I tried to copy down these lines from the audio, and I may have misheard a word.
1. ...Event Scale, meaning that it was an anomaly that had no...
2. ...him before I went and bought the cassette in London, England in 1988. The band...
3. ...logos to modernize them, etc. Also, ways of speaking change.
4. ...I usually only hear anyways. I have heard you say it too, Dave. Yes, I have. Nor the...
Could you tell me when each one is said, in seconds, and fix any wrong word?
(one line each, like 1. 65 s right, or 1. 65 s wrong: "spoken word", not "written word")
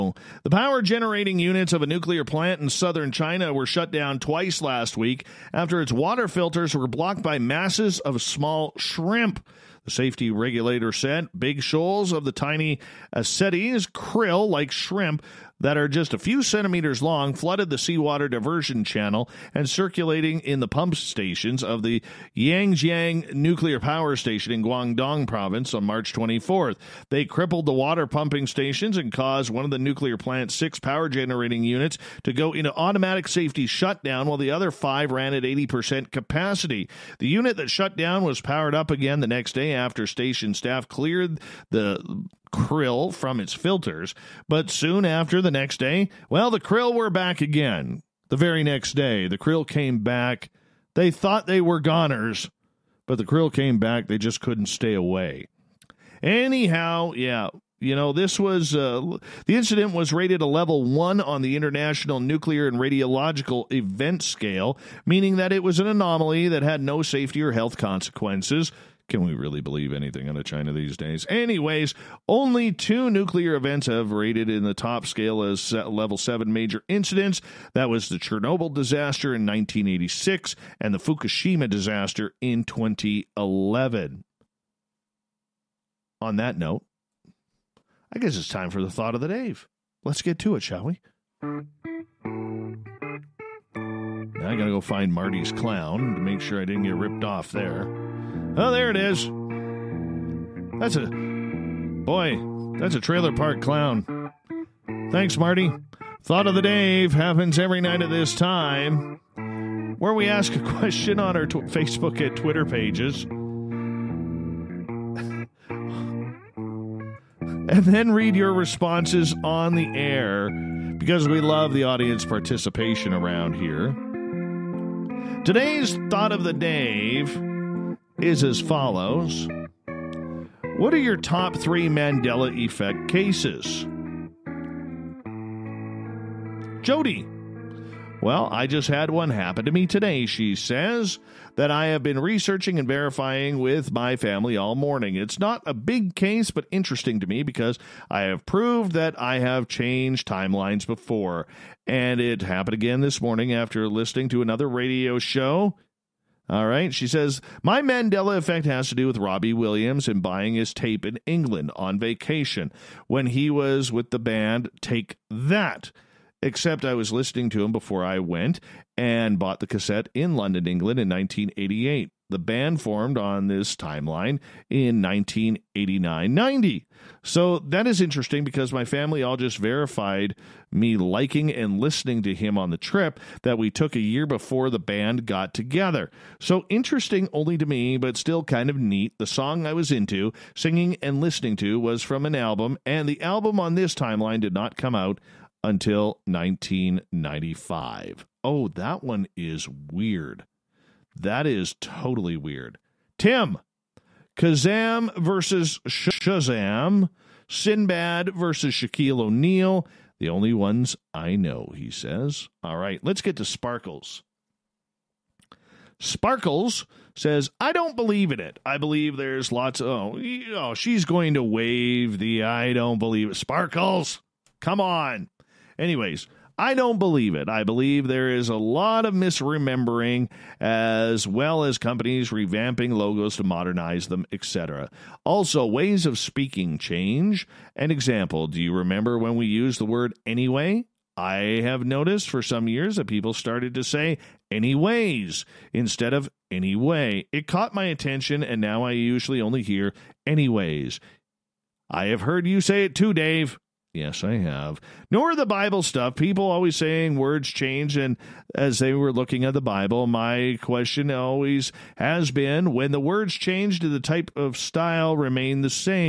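1. 63 s right
2. 167 s right
3. 232 s right
4. 248 s right.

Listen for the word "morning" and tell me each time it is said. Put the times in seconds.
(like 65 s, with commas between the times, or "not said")
144 s, 153 s.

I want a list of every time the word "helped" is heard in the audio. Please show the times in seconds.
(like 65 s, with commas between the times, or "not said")
not said.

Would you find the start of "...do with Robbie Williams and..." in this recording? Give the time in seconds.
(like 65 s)
158 s.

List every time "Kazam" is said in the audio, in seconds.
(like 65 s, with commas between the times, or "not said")
204 s.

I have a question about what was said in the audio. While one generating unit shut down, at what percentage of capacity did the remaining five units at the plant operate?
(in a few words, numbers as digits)
80%.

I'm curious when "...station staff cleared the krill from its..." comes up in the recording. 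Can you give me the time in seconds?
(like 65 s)
40 s.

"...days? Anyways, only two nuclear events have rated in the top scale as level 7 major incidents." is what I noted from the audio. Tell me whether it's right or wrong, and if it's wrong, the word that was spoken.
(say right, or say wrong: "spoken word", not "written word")
right.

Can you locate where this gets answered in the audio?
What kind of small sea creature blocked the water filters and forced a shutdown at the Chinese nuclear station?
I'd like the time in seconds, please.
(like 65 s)
13 s.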